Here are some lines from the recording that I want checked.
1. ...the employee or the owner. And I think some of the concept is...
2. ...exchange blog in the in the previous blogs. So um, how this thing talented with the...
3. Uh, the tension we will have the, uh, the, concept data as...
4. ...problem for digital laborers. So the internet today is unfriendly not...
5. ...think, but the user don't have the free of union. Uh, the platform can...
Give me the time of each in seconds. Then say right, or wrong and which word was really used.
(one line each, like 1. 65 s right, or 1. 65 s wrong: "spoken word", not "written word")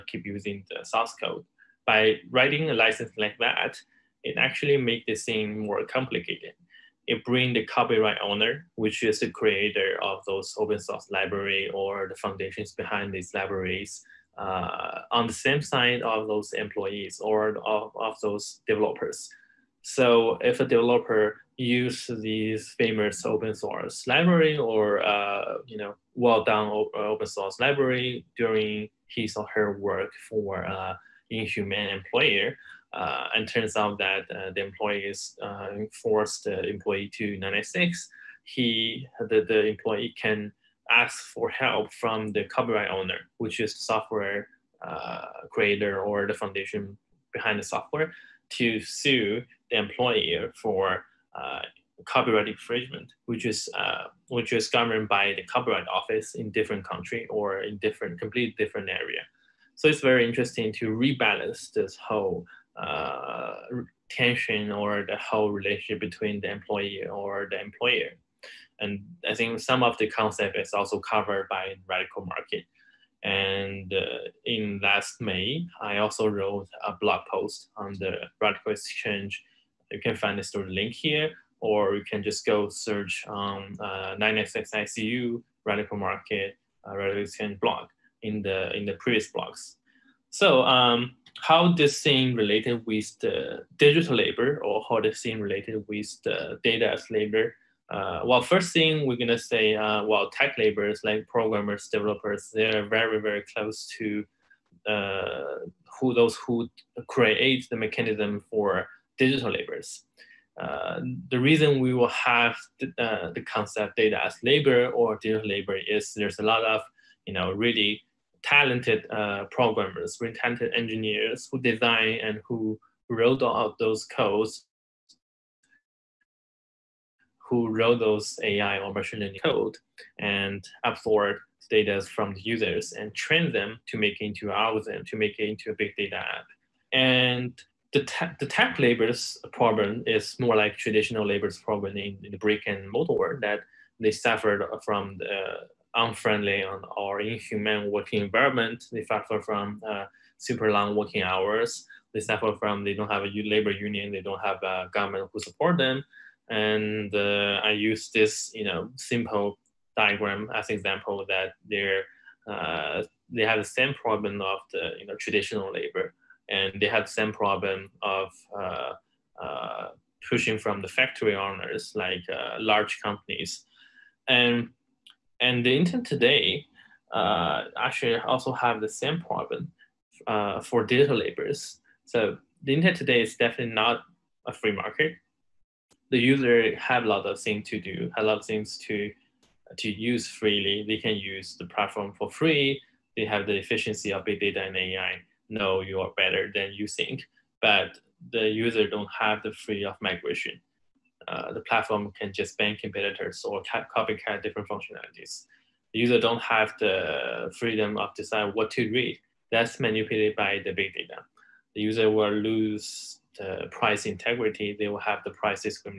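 1. 66 s wrong: "employer", not "owner"
2. 87 s wrong: "related", not "talented"
3. 110 s wrong: "reason", not "tension"
4. 179 s wrong: "definitely", not "unfriendly"
5. 196 s wrong: "migration", not "union".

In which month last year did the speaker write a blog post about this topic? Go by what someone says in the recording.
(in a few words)
May.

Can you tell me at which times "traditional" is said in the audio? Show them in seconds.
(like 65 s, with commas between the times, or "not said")
140 s, 165 s.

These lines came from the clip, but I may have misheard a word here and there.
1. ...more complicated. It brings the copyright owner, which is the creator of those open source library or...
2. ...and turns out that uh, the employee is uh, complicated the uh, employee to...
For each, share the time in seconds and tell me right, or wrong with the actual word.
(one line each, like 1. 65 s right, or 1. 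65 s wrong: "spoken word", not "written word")
1. 5 s right
2. 33 s wrong: "forced", not "complicated".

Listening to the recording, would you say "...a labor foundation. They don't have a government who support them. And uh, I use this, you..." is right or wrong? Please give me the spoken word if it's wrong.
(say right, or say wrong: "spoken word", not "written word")
wrong: "union", not "foundation".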